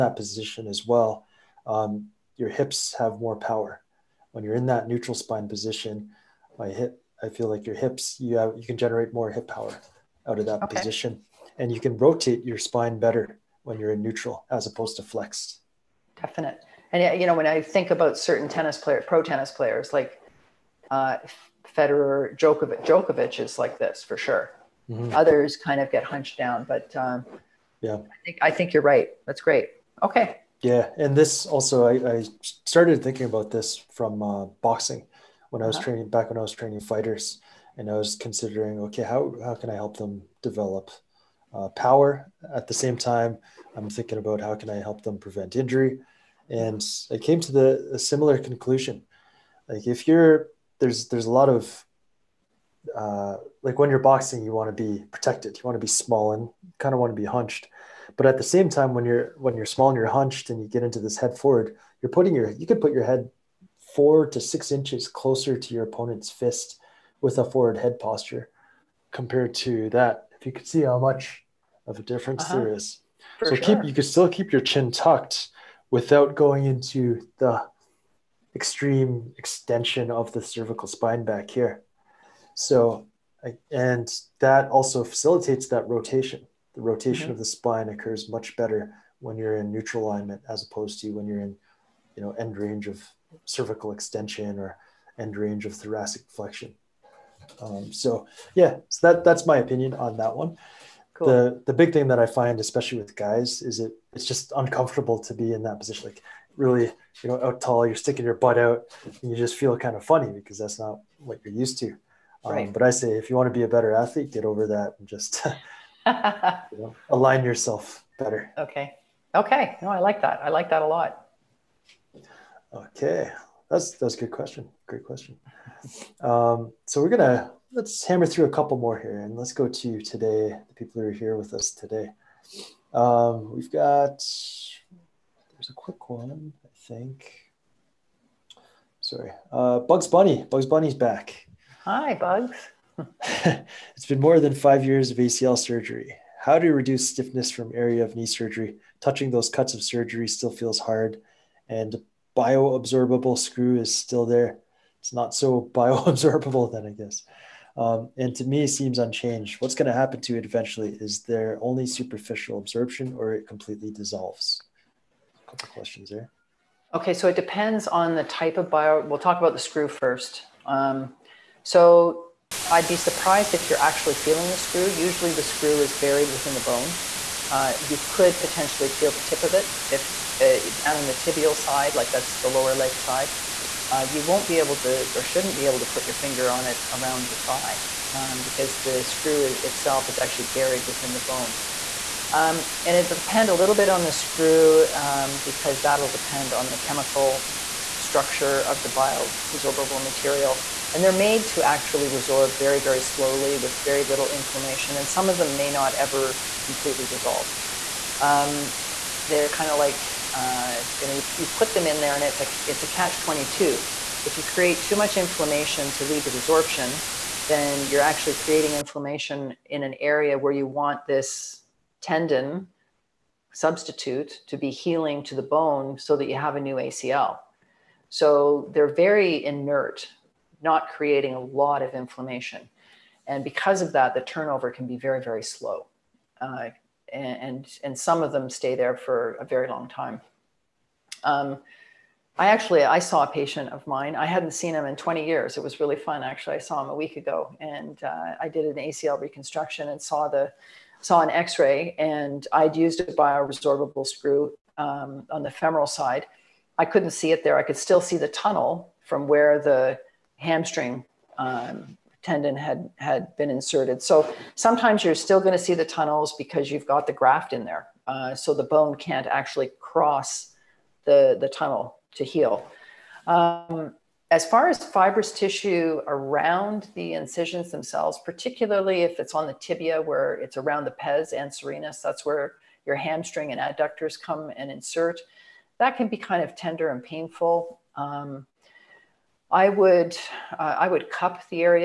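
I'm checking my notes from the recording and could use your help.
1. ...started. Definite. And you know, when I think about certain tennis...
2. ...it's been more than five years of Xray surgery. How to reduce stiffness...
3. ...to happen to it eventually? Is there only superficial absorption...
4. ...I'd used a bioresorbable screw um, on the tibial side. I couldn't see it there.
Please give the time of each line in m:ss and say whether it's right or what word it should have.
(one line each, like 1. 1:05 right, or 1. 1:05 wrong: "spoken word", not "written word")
1. 0:15 wrong: "flexed", not "started"
2. 2:23 wrong: "ACL", not "Xray"
3. 2:39 right
4. 4:12 wrong: "femoral", not "tibial".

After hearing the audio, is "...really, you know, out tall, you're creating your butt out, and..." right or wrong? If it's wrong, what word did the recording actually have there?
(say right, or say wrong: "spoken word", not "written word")
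wrong: "sticking", not "creating".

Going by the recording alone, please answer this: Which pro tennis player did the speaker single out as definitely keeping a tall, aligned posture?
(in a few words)
Djokovic.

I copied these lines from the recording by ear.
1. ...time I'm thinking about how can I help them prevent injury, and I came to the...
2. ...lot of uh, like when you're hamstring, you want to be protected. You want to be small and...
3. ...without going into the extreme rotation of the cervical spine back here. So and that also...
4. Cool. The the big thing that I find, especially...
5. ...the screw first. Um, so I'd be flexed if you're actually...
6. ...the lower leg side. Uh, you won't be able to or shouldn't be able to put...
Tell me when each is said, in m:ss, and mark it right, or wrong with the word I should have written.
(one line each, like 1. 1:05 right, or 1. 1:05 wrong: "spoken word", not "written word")
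1. 0:42 right
2. 0:51 wrong: "boxing", not "hamstring"
3. 1:15 wrong: "extension", not "rotation"
4. 1:41 right
5. 2:49 wrong: "surprised", not "flexed"
6. 3:02 right.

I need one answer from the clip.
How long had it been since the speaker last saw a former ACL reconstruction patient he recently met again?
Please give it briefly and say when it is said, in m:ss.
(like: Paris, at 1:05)
20 years, at 4:04.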